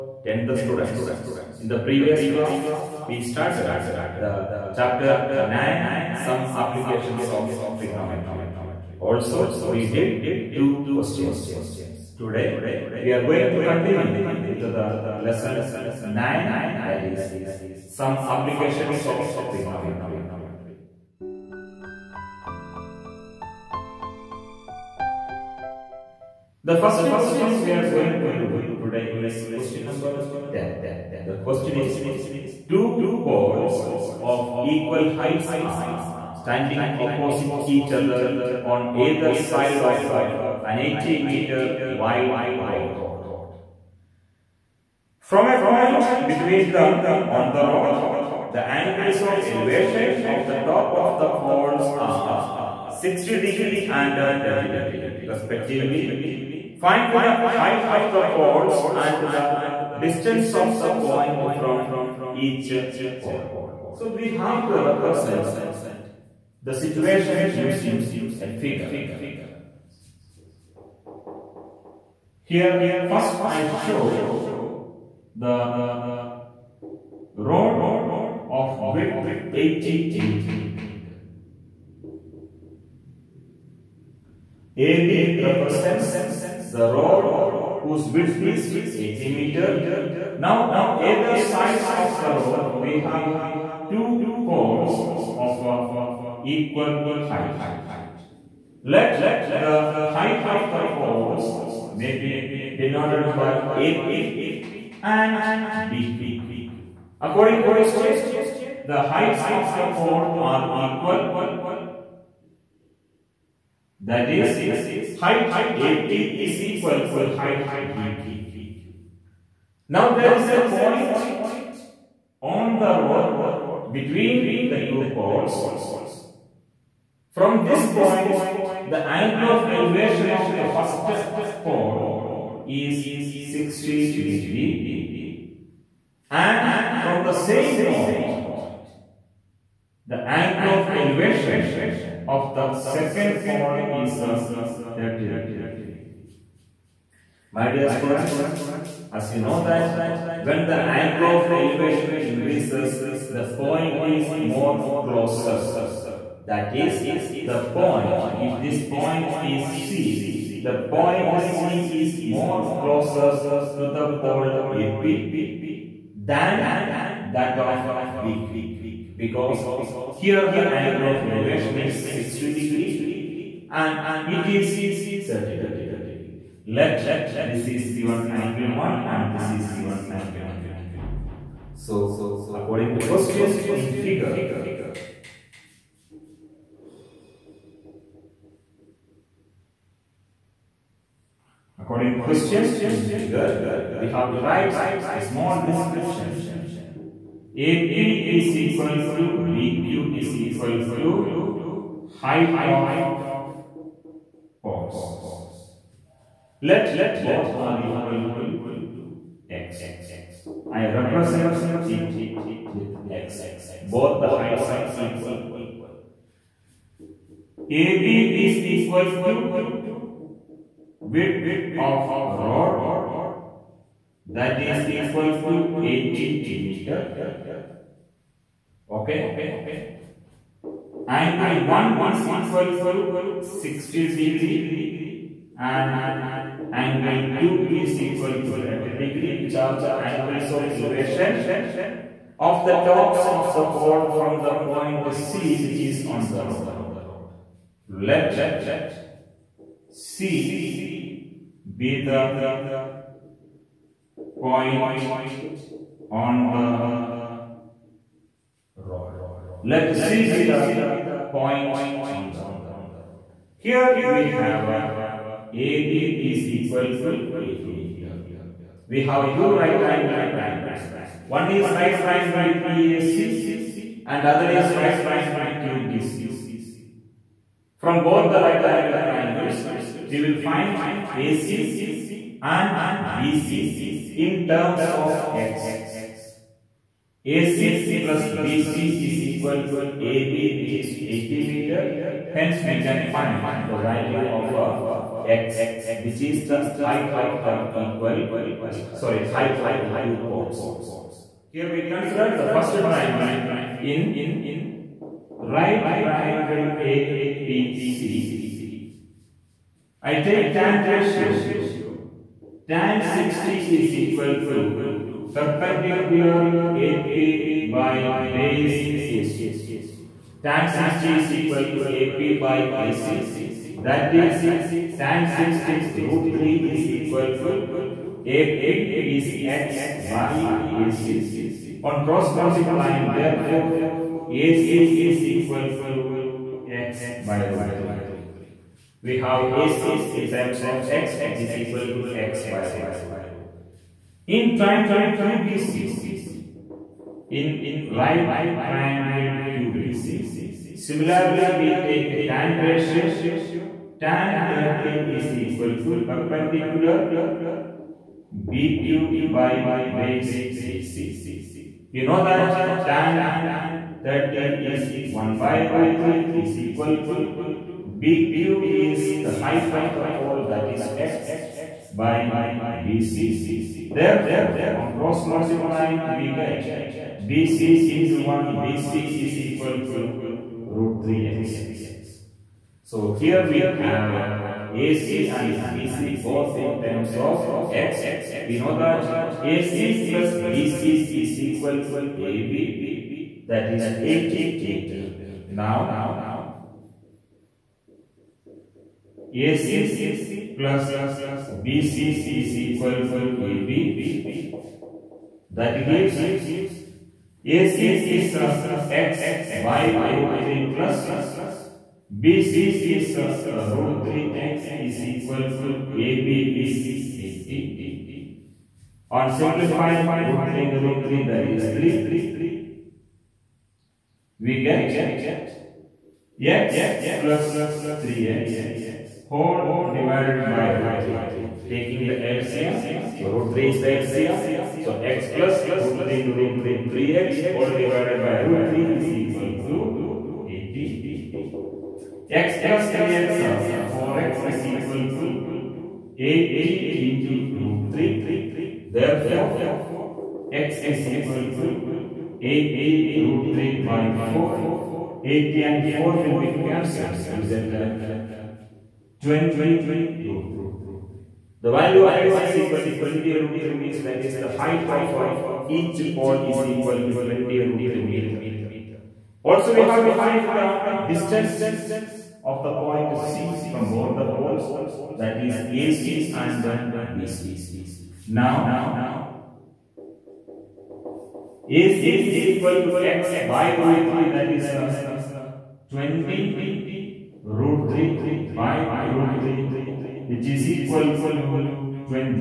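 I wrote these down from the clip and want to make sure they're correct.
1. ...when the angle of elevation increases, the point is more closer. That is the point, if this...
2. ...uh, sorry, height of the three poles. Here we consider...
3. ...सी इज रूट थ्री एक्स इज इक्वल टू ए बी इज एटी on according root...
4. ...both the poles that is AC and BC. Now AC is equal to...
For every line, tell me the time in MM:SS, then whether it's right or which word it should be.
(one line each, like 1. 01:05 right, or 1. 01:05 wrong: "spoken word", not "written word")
1. 02:30 right
2. 04:58 wrong: "two", not "three"
3. 06:52 wrong: "simplifying", not "according"
4. 07:53 right.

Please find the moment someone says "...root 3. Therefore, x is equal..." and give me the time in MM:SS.
07:27.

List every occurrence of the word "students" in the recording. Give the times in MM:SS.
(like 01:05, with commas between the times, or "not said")
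00:00, 02:27.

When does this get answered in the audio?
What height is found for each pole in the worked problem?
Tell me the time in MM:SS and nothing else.
07:47.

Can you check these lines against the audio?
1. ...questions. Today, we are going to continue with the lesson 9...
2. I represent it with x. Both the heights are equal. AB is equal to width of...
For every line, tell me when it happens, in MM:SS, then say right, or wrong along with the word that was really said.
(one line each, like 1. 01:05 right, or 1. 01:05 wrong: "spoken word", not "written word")
1. 00:10 right
2. 03:30 right.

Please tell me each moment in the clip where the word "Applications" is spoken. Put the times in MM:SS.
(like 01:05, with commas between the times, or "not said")
00:06, 00:18.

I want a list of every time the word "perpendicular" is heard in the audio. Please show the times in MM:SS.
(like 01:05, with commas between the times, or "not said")
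05:15, 05:56.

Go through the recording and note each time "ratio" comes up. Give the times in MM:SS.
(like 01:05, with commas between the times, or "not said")
05:10, 05:52.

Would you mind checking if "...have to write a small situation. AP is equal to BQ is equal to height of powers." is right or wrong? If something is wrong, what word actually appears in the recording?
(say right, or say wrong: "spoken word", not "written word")
wrong: "description", not "situation".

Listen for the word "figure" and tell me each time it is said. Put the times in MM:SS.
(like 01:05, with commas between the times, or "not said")
01:08, 03:04, 03:13.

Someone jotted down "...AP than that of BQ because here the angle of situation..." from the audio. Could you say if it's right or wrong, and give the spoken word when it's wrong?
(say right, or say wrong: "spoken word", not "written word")
wrong: "elevation", not "situation".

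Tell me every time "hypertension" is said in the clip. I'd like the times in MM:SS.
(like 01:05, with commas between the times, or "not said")
not said.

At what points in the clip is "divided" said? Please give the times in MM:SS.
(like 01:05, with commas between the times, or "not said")
07:09, 07:17.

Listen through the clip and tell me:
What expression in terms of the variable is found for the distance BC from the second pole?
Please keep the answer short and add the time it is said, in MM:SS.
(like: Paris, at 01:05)
root 3x, at 06:20.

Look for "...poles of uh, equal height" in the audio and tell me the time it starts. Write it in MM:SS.
01:34.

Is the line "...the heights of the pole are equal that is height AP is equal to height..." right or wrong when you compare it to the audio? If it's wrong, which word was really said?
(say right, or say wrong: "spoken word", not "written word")
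right.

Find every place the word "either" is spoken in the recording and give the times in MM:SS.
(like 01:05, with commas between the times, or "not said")
00:38, 01:31.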